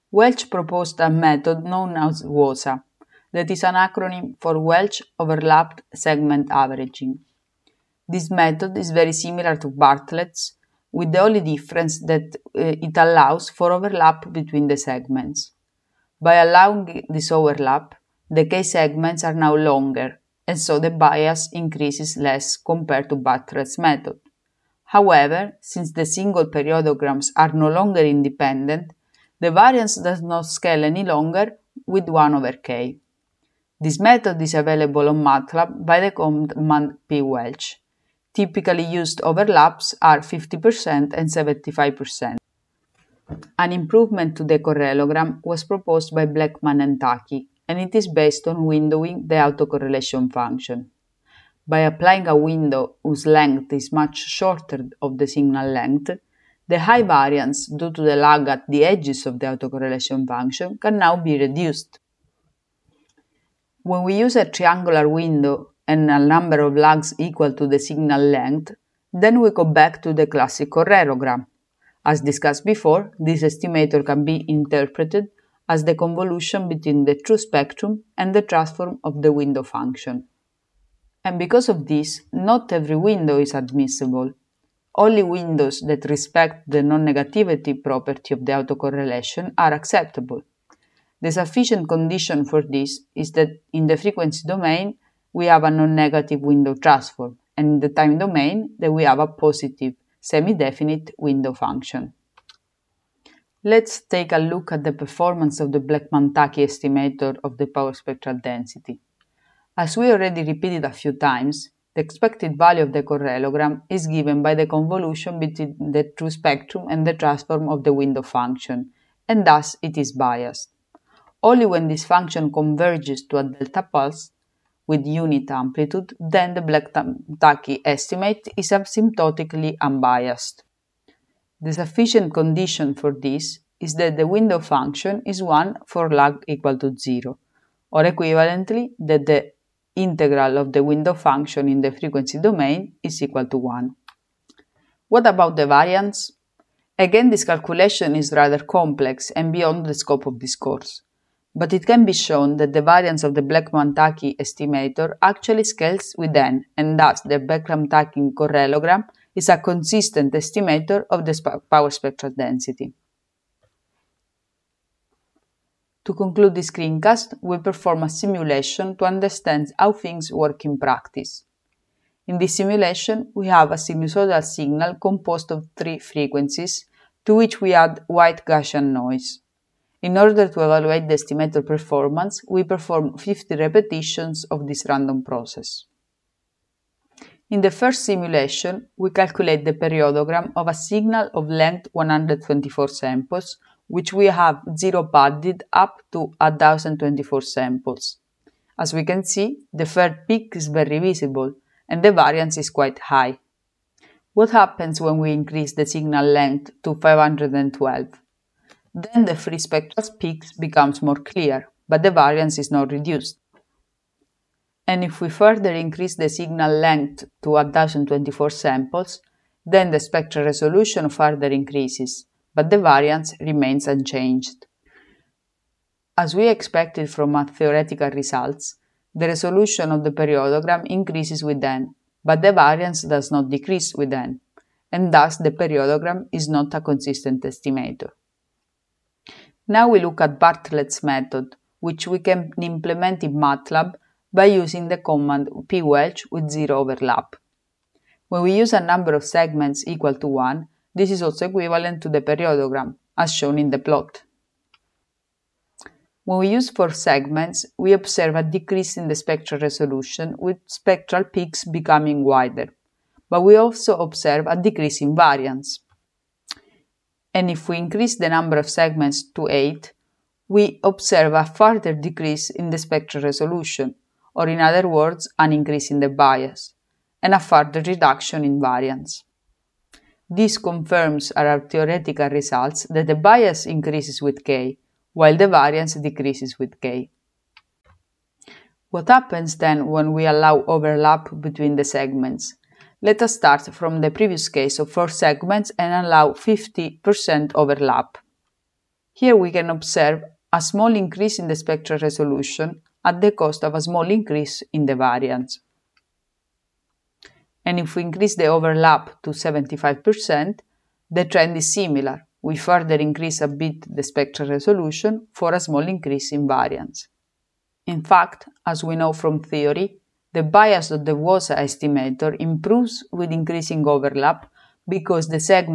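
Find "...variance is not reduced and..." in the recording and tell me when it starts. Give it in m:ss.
3:32.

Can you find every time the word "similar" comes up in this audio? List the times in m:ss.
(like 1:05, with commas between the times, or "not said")
0:09, 5:11.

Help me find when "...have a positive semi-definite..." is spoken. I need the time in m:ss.
1:39.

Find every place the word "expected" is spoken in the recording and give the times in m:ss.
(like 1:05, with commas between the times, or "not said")
1:52, 3:46.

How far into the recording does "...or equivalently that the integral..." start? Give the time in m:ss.
2:17.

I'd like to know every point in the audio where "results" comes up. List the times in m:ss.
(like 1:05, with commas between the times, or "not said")
3:48, 4:42.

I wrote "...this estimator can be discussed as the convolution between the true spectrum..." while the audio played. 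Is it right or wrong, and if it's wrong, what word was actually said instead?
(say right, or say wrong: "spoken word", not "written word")
wrong: "interpreted", not "discussed".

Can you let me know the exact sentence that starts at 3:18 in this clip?
As we can see, the third peak is very visible and the variance is quite high.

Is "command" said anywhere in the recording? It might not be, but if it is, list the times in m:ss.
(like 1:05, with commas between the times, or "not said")
0:36, 4:04.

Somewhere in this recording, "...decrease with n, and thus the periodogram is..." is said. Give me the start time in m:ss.
3:53.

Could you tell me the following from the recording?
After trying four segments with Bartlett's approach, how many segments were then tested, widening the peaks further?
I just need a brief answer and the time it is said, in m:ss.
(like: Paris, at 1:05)
8, at 4:29.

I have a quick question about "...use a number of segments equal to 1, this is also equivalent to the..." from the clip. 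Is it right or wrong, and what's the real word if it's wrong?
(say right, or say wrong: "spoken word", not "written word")
right.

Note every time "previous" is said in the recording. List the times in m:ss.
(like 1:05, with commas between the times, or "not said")
4:54.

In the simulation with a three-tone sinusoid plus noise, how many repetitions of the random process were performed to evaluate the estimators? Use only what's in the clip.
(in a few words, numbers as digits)
50.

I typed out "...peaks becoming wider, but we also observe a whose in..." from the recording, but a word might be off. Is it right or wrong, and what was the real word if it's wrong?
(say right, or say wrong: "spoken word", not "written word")
wrong: "decrease", not "whose".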